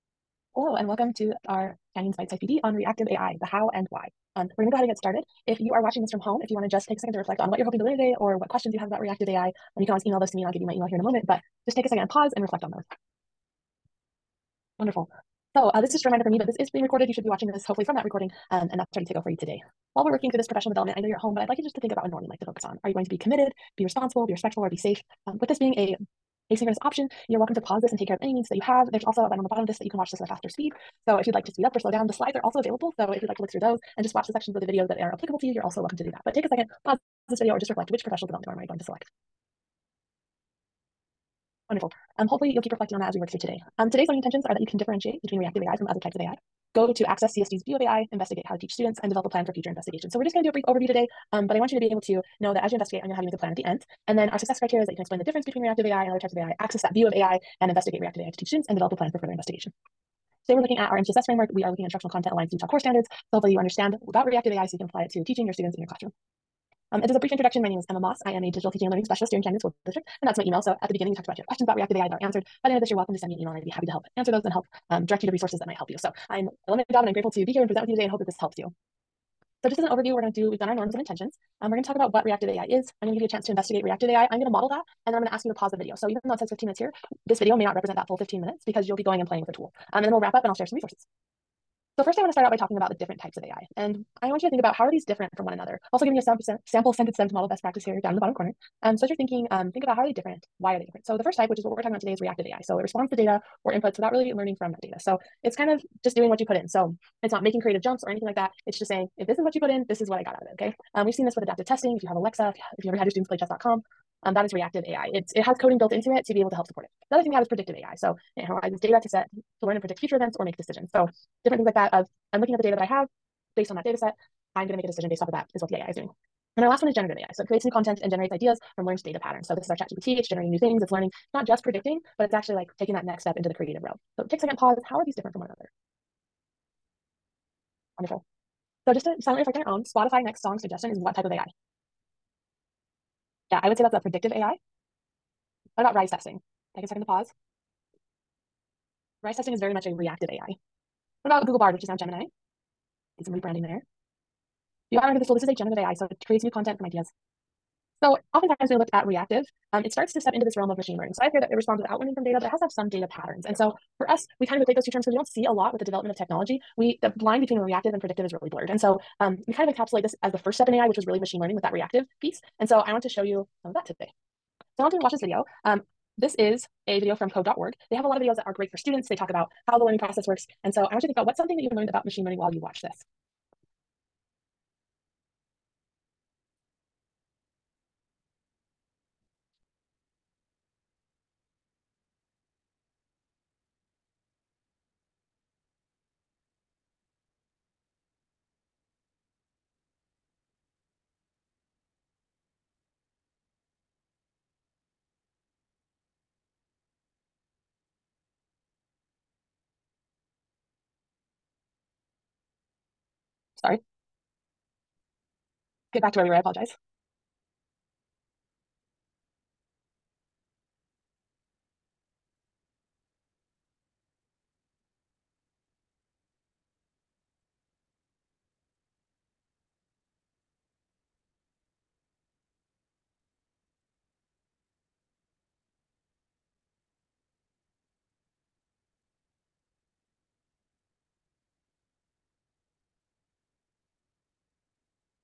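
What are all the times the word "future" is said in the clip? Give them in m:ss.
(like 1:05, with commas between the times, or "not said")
0:49, 1:59.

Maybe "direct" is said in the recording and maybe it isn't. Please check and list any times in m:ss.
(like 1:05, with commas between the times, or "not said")
1:15.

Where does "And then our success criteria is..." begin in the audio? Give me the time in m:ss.
0:54.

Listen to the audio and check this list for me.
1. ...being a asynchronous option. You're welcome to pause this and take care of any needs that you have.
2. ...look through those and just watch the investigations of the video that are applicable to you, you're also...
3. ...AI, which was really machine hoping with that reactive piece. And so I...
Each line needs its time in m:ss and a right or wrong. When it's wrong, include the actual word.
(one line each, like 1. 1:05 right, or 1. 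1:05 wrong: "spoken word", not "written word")
1. 0:25 right
2. 0:33 wrong: "sections", not "investigations"
3. 2:50 wrong: "learning", not "hoping".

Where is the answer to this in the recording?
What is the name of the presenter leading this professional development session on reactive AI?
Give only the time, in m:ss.
1:07.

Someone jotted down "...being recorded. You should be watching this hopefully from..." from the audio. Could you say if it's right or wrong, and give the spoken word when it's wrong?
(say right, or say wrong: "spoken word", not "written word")
right.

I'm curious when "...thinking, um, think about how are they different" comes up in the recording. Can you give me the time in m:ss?
1:39.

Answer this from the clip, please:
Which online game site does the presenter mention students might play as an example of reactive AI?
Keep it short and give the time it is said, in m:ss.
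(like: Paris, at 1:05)
chess.com, at 1:53.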